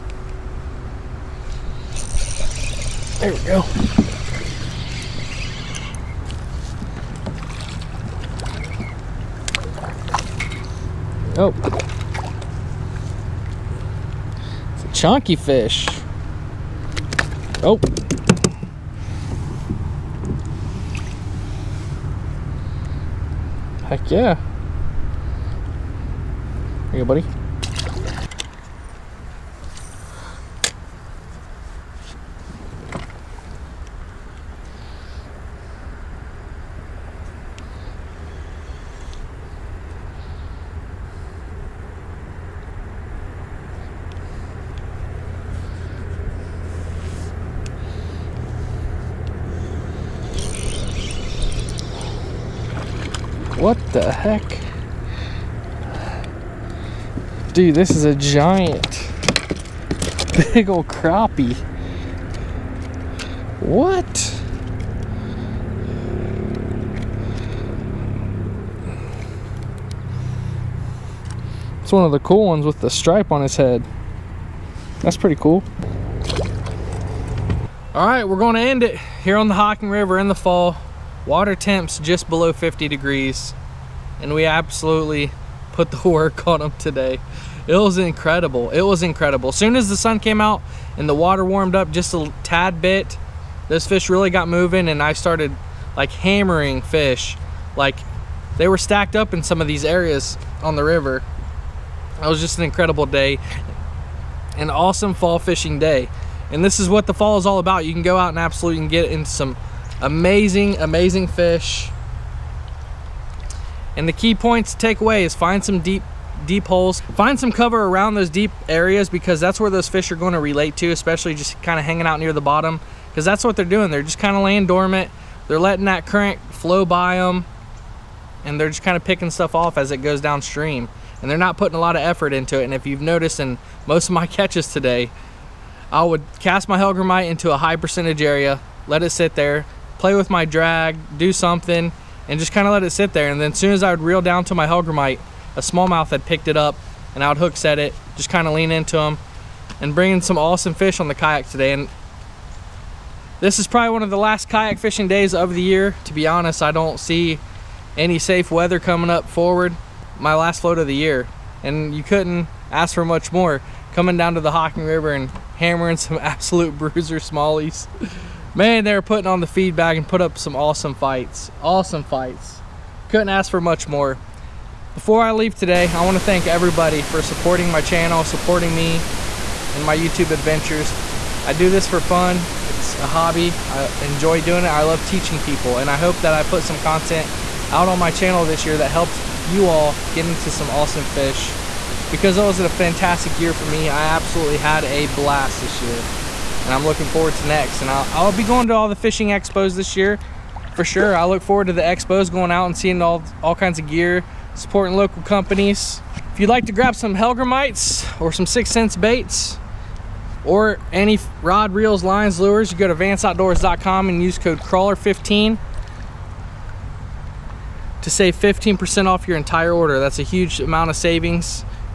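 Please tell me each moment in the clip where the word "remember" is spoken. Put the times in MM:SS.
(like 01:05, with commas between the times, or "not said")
not said.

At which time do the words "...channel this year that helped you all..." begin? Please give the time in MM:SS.
03:08.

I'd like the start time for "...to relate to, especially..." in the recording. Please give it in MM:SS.
02:00.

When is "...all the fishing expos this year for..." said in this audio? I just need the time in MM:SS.
03:18.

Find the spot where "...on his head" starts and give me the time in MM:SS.
01:13.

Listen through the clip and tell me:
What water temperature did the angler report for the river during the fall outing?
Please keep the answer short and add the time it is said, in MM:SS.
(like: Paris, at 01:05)
just below 50 degrees, at 01:21.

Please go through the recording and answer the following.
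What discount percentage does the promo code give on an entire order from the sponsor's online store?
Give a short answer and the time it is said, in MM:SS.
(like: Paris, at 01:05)
15%, at 03:38.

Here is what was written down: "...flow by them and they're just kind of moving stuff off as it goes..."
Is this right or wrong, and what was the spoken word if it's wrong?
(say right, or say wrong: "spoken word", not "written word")
wrong: "picking", not "moving".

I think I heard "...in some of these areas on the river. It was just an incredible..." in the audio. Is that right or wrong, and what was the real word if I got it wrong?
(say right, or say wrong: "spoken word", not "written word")
right.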